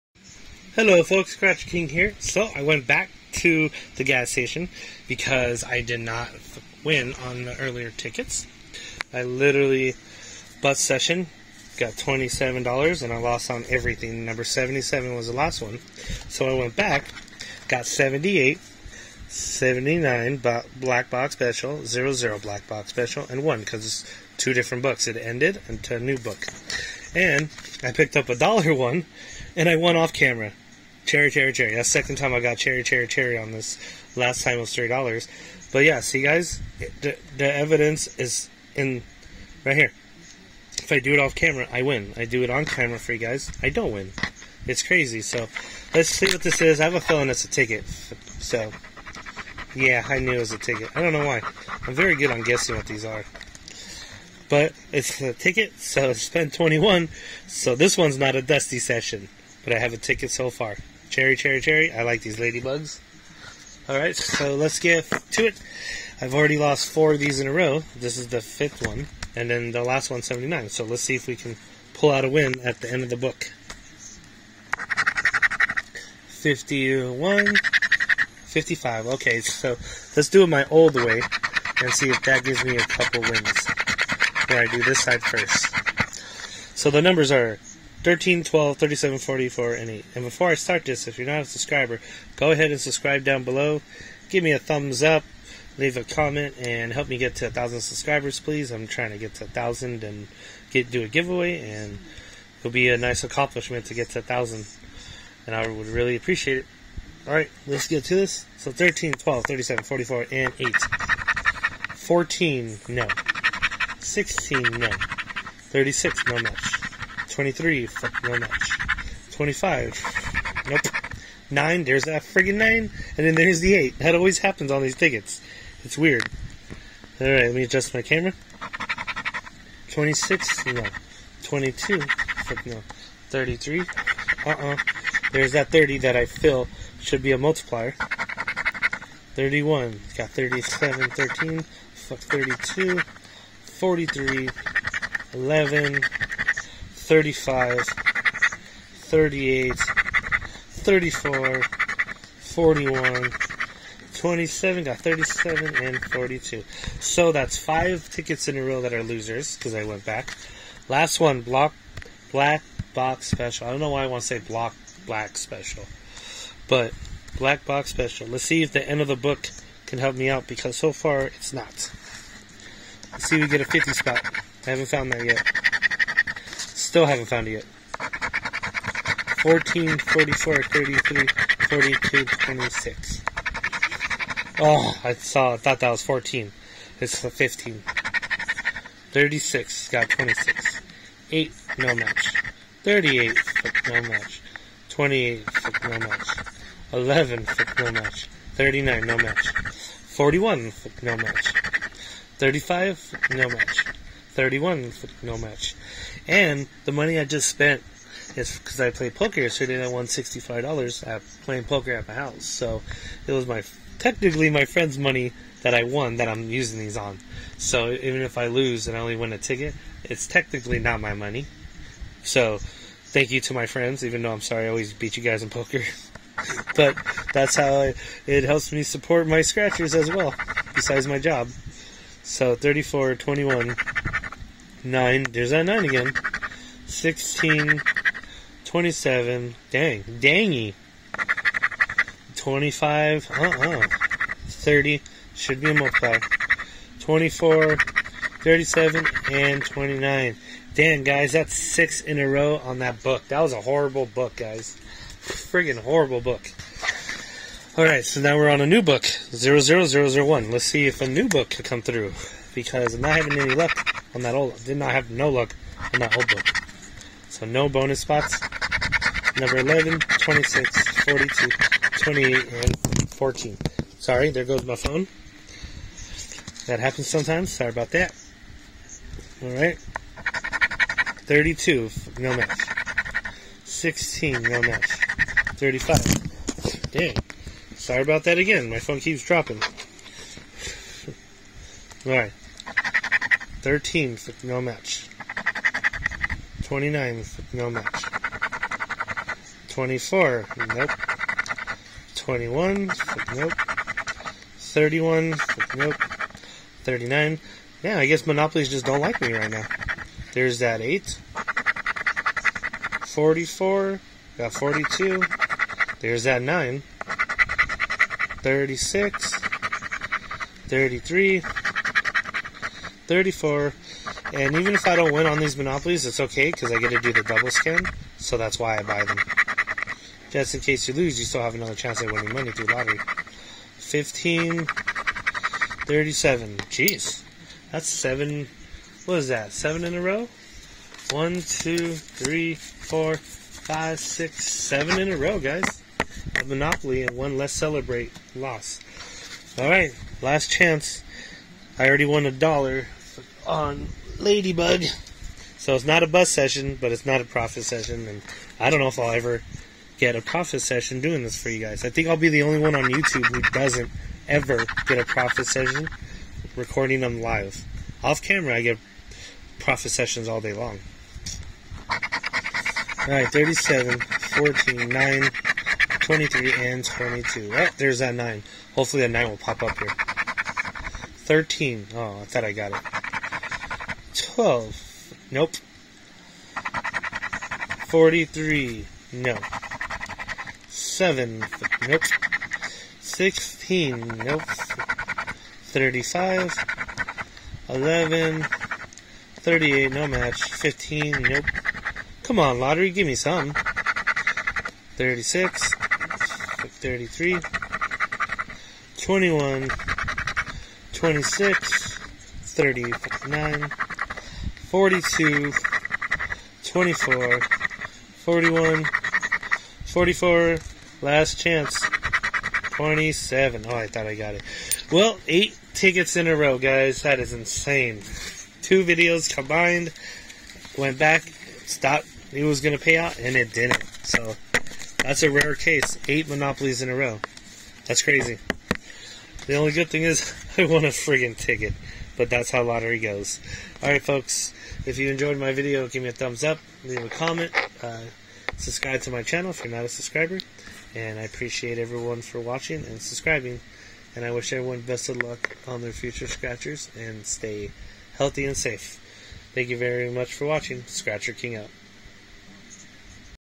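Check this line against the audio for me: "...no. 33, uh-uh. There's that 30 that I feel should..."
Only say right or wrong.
right.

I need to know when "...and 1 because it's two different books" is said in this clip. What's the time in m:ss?
0:23.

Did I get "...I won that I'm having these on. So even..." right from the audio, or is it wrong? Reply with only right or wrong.
wrong.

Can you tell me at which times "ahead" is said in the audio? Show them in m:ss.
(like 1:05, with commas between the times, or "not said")
1:32.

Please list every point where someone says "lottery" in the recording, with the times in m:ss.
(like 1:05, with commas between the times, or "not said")
5:32, 7:22.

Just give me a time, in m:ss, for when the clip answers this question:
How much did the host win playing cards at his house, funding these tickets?
3:30.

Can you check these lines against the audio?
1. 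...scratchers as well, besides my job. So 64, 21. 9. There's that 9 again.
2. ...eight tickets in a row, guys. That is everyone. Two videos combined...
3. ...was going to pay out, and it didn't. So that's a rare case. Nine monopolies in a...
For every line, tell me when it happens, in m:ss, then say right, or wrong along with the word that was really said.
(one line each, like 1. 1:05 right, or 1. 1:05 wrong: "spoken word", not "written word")
1. 3:49 wrong: "34", not "64"
2. 7:05 wrong: "insane", not "everyone"
3. 7:12 wrong: "Eight", not "Nine".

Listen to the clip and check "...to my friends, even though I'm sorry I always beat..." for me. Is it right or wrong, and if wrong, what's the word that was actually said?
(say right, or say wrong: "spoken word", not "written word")
right.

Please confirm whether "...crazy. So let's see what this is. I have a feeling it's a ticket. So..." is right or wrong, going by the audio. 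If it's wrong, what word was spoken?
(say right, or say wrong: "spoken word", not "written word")
right.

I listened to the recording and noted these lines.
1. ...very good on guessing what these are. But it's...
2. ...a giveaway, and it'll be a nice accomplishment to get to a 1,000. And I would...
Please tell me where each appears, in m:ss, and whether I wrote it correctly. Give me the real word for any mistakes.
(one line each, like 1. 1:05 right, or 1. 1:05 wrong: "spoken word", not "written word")
1. 0:51 right
2. 1:41 right.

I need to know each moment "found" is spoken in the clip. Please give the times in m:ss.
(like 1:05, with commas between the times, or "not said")
2:54.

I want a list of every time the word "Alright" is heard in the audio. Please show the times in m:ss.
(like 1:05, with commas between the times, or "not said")
1:03, 1:47, 2:07, 6:13, 7:23.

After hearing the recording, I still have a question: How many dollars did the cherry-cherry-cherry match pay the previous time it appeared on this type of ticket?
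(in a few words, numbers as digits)
$3.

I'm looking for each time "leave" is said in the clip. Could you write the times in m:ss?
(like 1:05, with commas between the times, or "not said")
1:35, 7:26.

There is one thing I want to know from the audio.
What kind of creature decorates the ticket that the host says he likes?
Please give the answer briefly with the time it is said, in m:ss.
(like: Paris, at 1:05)
Ladybugs, at 1:02.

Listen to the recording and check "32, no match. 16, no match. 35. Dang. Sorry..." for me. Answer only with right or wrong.
right.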